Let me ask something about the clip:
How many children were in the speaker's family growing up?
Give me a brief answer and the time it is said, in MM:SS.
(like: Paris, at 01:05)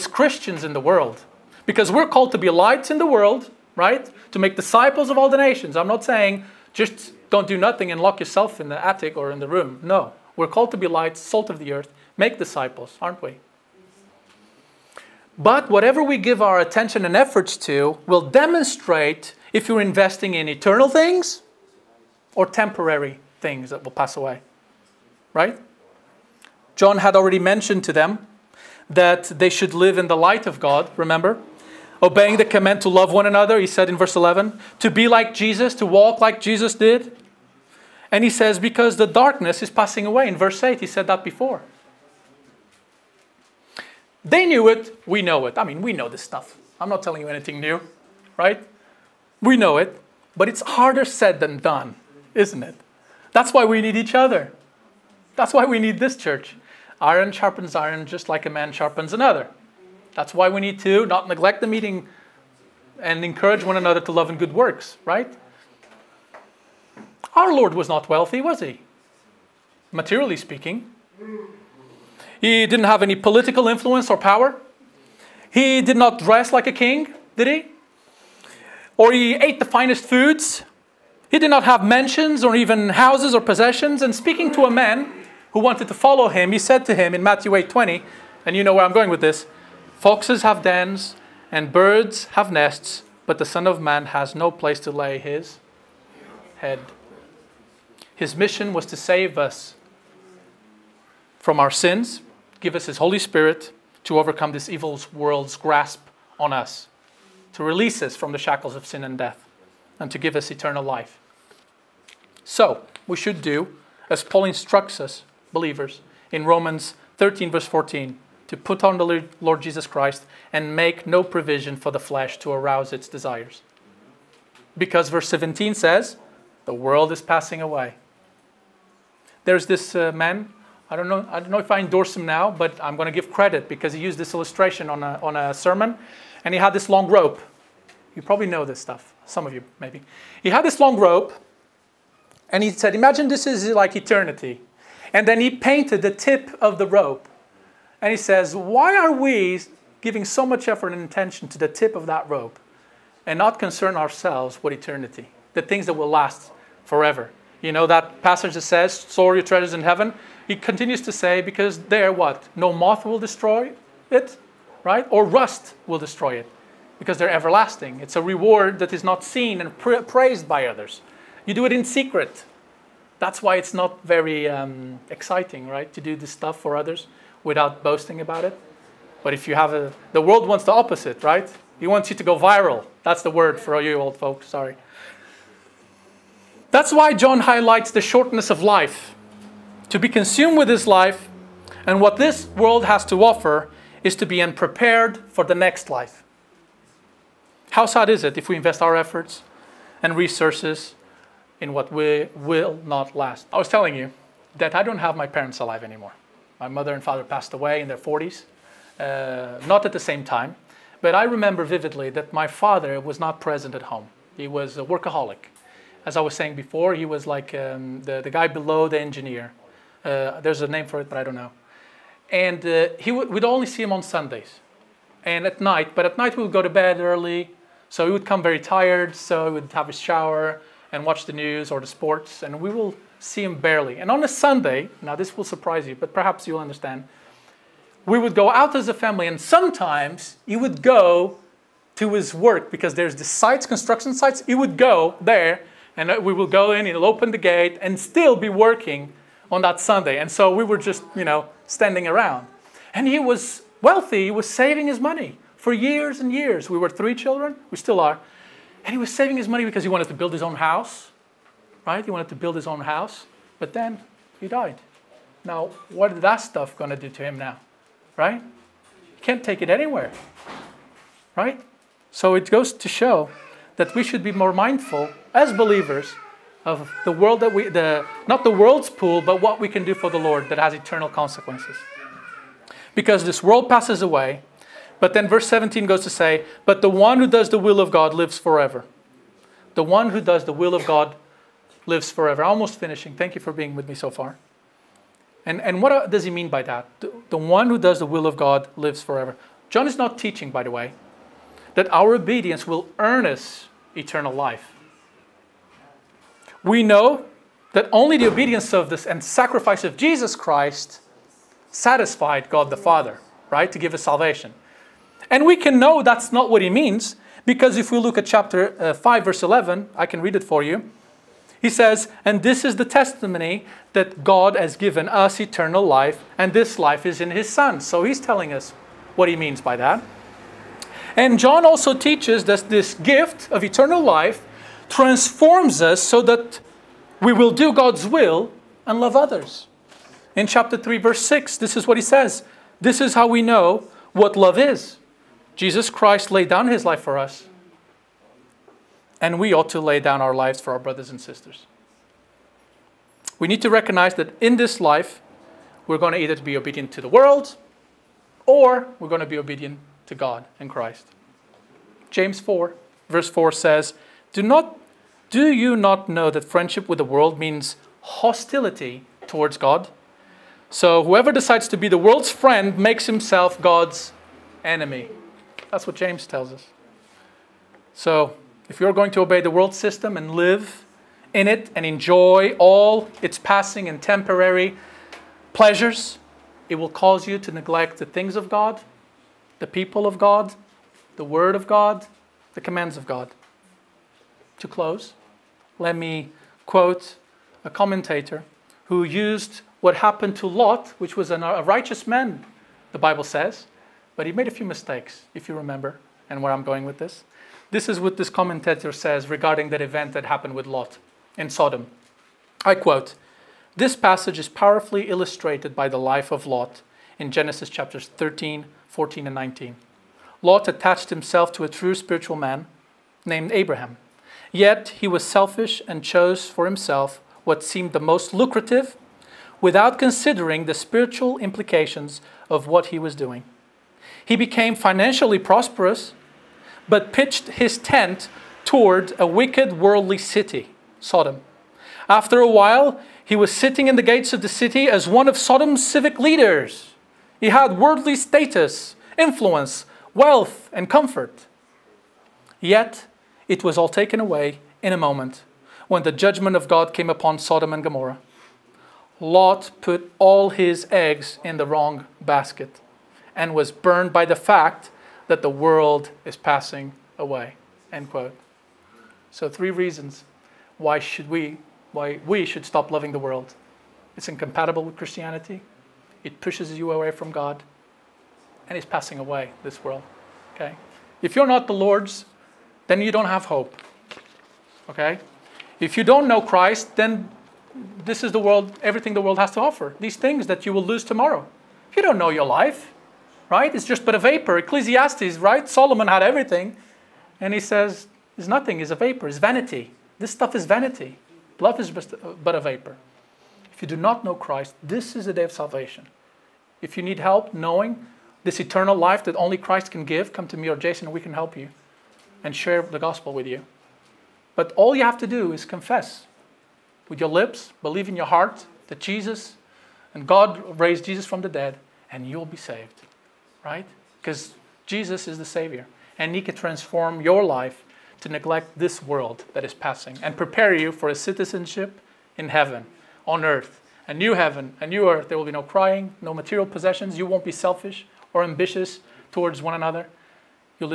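3, at 04:16.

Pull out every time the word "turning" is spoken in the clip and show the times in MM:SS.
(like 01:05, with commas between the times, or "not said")
not said.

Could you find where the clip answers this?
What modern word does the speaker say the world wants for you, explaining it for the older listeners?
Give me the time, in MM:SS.
03:02.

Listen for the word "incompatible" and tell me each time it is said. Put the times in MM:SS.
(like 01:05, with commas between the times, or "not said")
07:54.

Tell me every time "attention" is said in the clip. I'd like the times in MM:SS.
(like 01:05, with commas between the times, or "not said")
00:16, 02:31.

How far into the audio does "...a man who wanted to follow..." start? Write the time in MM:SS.
01:24.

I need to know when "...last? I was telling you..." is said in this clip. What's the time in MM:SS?
03:23.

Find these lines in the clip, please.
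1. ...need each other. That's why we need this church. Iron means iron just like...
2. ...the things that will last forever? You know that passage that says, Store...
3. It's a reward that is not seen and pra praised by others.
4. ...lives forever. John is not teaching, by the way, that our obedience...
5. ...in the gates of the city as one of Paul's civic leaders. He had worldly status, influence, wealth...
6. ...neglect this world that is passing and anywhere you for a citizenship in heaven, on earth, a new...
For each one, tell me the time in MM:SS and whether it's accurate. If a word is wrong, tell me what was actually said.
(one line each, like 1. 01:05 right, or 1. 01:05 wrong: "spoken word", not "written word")
1. 00:53 wrong: "sharpens", not "means"
2. 02:35 right
3. 02:48 right
4. 04:58 right
5. 07:23 wrong: "Sodom", not "Paul"
6. 08:48 wrong: "prepare", not "anywhere".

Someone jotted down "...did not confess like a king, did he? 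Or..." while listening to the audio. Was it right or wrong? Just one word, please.
wrong.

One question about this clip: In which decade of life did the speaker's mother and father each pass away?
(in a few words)
40s.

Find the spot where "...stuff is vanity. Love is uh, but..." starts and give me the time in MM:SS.
08:20.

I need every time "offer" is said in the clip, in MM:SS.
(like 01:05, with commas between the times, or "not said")
03:13, 08:09.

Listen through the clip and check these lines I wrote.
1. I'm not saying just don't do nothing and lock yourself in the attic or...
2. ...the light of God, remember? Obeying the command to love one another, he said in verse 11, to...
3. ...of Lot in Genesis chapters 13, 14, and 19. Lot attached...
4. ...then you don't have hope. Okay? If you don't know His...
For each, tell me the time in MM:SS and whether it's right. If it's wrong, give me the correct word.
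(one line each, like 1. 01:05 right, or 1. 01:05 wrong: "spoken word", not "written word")
1. 00:05 right
2. 00:30 right
3. 06:56 right
4. 08:02 wrong: "Christ", not "His".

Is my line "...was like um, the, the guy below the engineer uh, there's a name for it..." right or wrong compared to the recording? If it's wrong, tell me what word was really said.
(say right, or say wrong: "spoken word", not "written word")
right.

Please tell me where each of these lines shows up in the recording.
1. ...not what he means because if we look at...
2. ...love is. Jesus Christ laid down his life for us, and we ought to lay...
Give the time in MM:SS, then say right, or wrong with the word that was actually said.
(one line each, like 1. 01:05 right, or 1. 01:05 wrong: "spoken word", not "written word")
1. 05:16 right
2. 05:44 right.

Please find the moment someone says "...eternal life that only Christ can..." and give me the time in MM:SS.
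08:28.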